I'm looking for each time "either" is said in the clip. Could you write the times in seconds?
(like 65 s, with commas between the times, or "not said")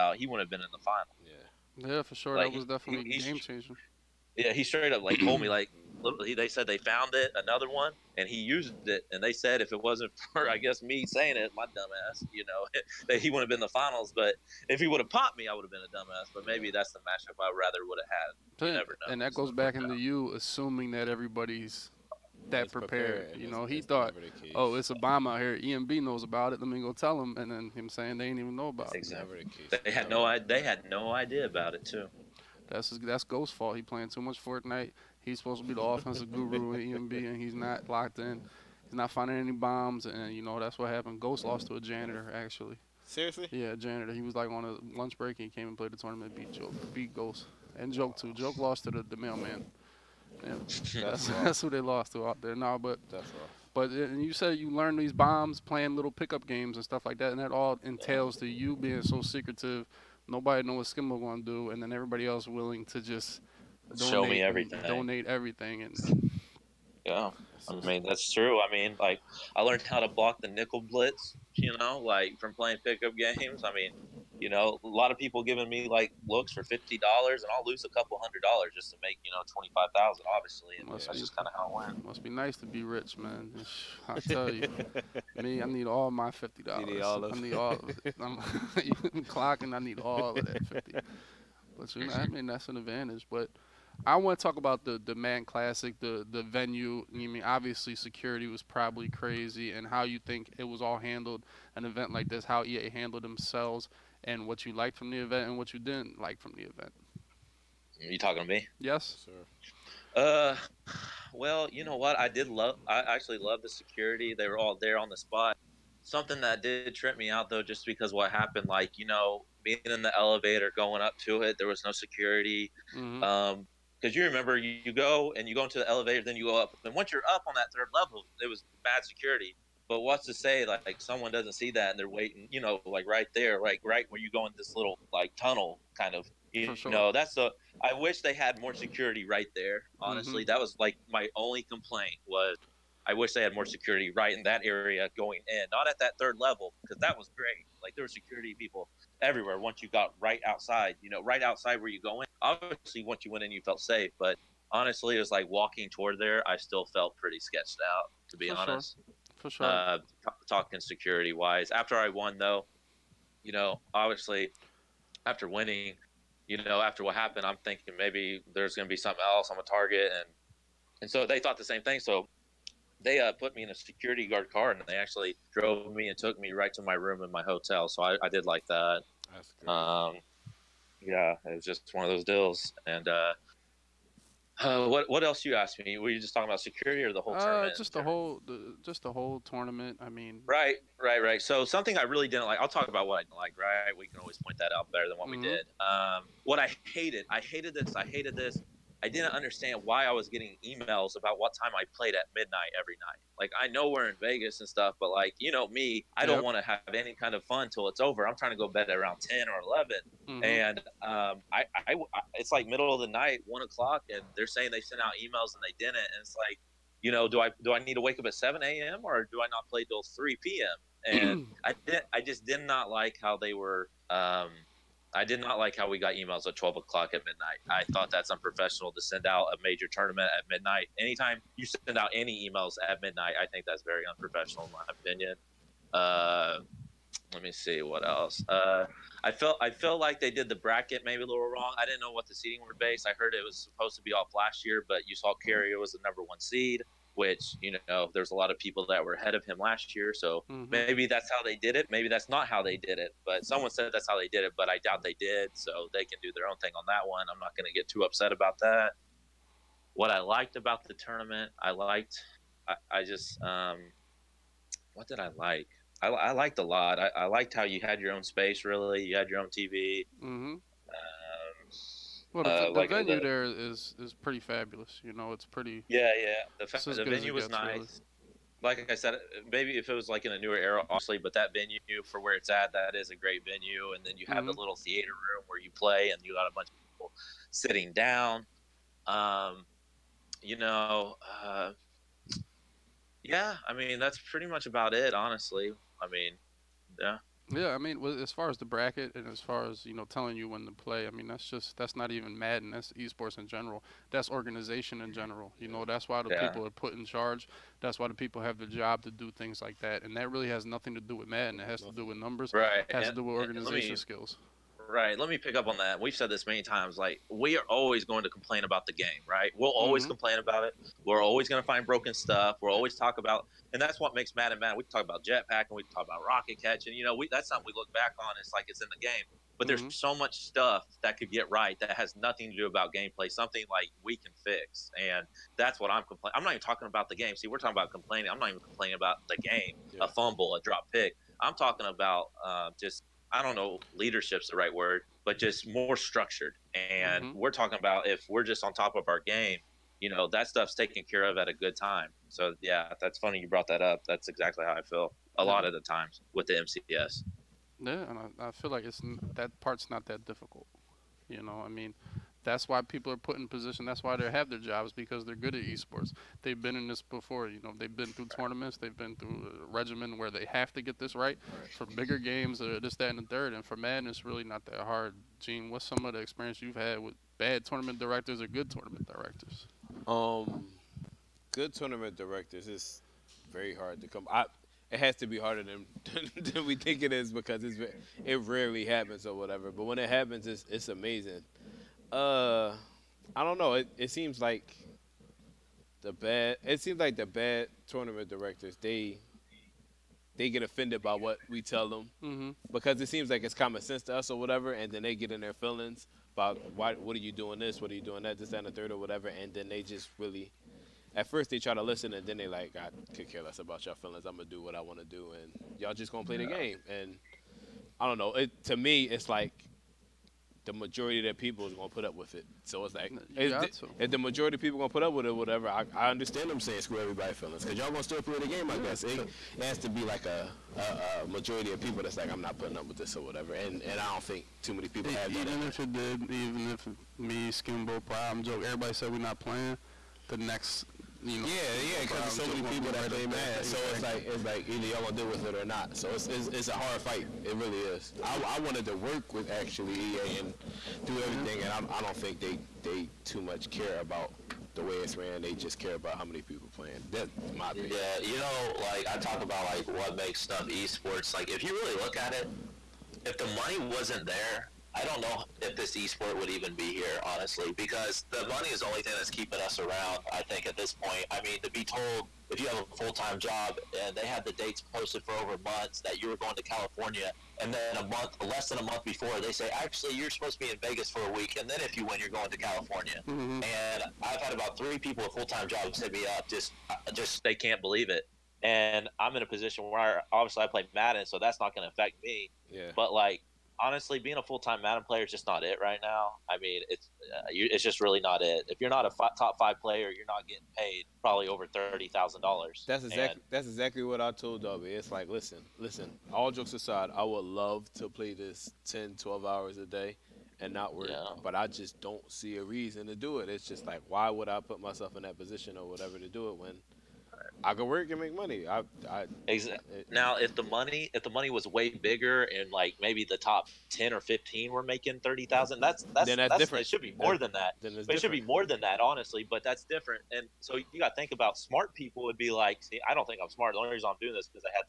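444 s.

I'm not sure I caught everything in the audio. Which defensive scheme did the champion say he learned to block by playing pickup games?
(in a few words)
nickel blitz.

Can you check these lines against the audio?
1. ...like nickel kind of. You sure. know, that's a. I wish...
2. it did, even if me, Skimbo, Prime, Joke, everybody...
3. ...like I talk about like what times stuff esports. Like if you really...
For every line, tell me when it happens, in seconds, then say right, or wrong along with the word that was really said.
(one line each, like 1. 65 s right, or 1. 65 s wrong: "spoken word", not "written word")
1. 135 s wrong: "tunnel", not "nickel"
2. 435 s right
3. 458 s wrong: "makes", not "times".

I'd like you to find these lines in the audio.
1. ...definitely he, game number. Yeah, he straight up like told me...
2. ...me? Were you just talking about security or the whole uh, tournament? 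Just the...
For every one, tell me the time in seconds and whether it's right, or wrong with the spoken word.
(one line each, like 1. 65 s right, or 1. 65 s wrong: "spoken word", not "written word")
1. 2 s wrong: "changer", not "number"
2. 185 s right.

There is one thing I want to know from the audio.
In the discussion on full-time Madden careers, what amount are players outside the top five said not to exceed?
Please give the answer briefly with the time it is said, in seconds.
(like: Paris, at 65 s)
$30,000, at 501 s.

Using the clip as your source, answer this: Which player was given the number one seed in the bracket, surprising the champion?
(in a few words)
Carrier.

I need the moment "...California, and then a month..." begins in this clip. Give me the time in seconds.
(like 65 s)
476 s.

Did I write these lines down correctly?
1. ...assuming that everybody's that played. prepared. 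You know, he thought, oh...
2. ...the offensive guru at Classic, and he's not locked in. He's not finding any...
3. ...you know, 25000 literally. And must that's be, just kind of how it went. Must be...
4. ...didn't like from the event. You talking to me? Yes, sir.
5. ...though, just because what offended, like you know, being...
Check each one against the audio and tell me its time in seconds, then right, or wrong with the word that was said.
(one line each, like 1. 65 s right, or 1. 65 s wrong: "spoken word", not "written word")
1. 20 s wrong: "prepared", not "played"
2. 35 s wrong: "EMB", not "Classic"
3. 79 s wrong: "obviously", not "literally"
4. 105 s right
5. 117 s wrong: "happened", not "offended".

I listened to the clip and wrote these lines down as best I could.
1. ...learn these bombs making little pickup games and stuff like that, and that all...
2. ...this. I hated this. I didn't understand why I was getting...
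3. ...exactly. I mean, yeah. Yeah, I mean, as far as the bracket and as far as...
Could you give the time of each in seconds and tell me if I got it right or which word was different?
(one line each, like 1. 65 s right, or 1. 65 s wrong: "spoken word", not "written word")
1. 54 s wrong: "playing", not "making"
2. 197 s right
3. 295 s wrong: "honestly", not "exactly".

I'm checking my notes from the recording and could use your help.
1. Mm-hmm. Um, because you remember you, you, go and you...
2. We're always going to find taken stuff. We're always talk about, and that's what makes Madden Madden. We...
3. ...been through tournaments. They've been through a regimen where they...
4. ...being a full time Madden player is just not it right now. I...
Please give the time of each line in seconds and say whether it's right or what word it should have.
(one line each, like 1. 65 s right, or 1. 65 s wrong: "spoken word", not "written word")
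1. 122 s right
2. 321 s wrong: "broken", not "taken"
3. 367 s right
4. 494 s right.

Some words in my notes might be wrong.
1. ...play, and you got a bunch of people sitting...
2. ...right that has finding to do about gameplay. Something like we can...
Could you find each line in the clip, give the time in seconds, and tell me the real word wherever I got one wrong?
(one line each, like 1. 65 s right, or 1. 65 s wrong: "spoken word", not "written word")
1. 285 s right
2. 331 s wrong: "nothing", not "finding".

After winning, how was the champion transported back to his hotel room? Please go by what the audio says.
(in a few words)
security guard car.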